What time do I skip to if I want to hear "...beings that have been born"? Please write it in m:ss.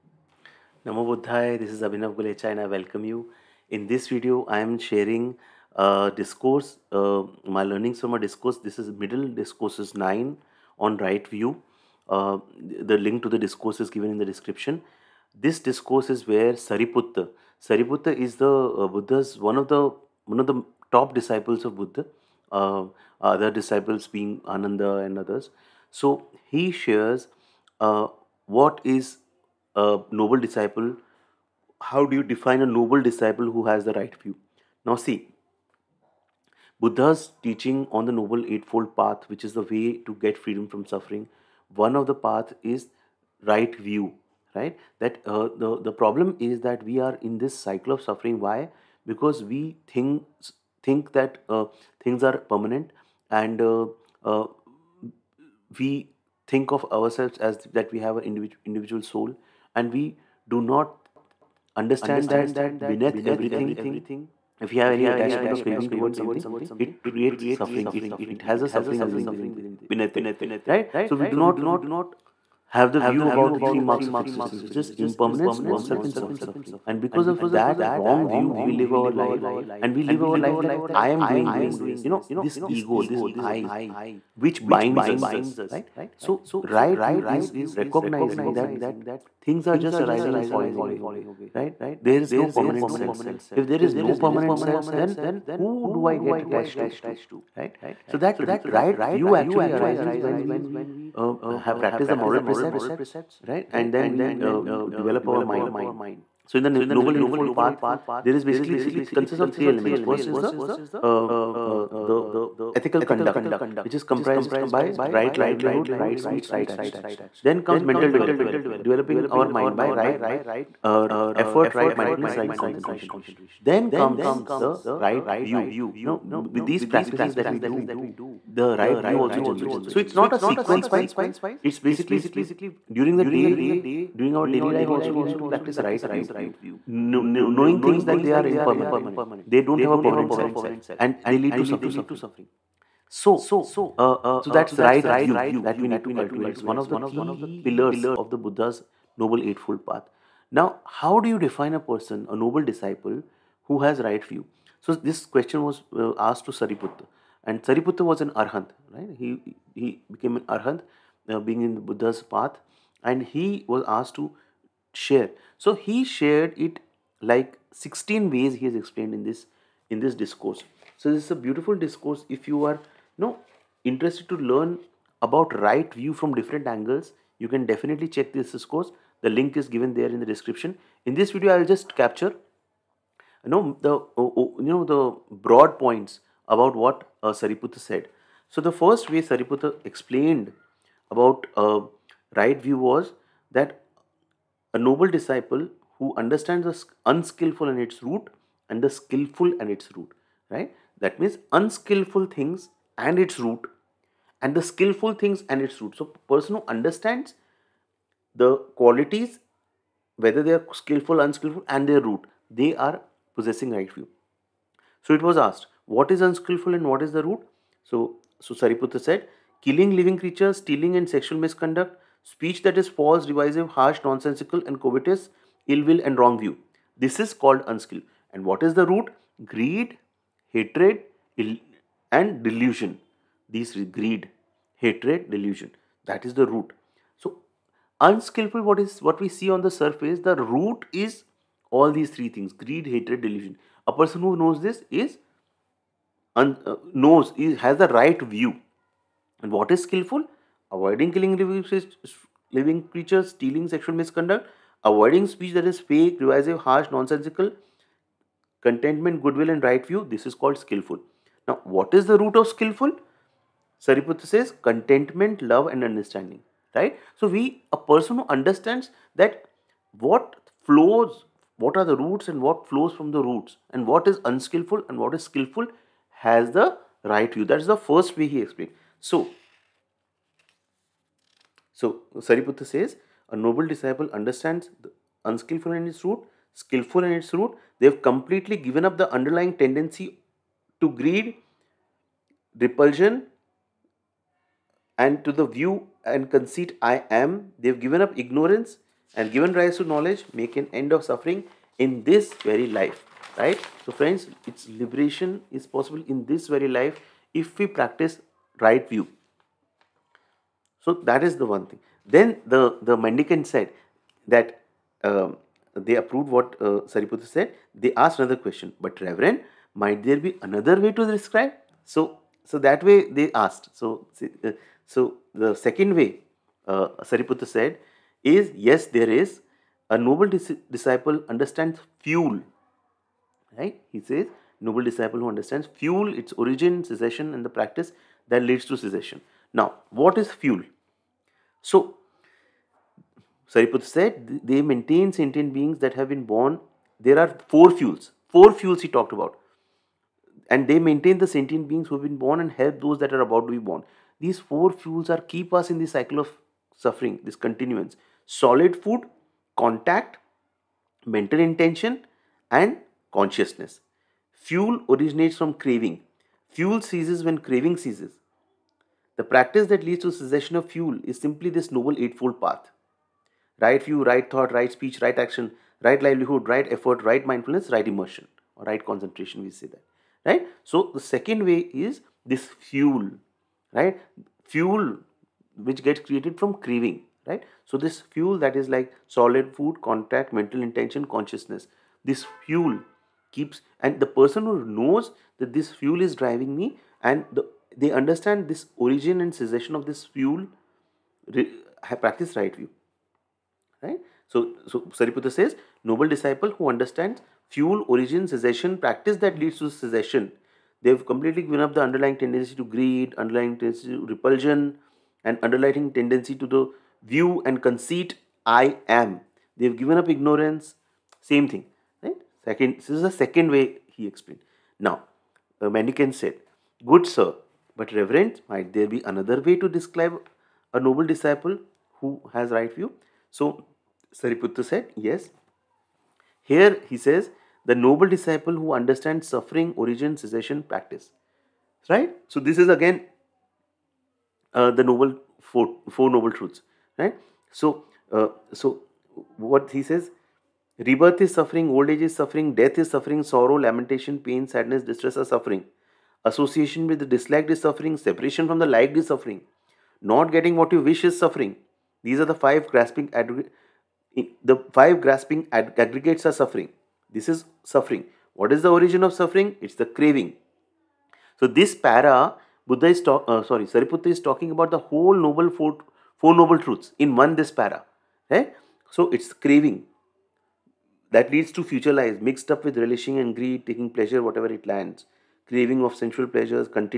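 5:45.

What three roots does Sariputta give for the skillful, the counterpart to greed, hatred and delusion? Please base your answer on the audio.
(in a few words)
Contentment, love, and understanding.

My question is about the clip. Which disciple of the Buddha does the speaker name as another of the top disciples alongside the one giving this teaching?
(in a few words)
Ananda.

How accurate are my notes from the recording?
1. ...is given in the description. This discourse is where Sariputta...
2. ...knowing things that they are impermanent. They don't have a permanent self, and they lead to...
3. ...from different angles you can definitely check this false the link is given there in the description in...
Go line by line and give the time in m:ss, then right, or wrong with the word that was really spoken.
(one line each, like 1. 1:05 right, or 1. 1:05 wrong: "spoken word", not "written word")
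1. 0:13 right
2. 2:16 right
3. 2:56 wrong: "course", not "false".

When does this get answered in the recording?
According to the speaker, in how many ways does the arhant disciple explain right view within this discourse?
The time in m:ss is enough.
2:47.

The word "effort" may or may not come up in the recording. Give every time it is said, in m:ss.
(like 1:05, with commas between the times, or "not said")
2:01, 6:16.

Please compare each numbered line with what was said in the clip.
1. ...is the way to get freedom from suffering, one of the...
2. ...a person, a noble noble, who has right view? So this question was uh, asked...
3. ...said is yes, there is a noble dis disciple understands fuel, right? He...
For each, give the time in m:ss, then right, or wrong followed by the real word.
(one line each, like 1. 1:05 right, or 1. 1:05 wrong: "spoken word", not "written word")
1. 0:39 right
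2. 2:31 wrong: "disciple", not "noble"
3. 5:27 right.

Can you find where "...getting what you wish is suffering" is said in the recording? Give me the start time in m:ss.
7:40.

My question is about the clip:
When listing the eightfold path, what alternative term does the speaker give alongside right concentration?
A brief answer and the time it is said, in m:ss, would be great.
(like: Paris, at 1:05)
Right immersion, at 6:17.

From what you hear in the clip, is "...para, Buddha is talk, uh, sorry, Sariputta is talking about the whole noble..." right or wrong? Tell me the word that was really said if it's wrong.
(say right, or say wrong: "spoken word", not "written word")
right.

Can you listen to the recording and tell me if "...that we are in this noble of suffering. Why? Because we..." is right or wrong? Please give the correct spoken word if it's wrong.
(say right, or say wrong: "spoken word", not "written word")
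wrong: "cycle", not "noble".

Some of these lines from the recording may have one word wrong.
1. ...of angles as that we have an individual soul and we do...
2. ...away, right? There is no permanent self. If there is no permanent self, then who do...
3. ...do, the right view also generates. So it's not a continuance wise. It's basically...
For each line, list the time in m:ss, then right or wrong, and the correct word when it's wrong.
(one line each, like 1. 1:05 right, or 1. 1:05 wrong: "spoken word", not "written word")
1. 0:56 wrong: "ourselves", not "angles"
2. 1:30 right
3. 2:07 wrong: "sequence", not "continuance".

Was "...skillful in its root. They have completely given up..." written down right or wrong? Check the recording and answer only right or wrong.
right.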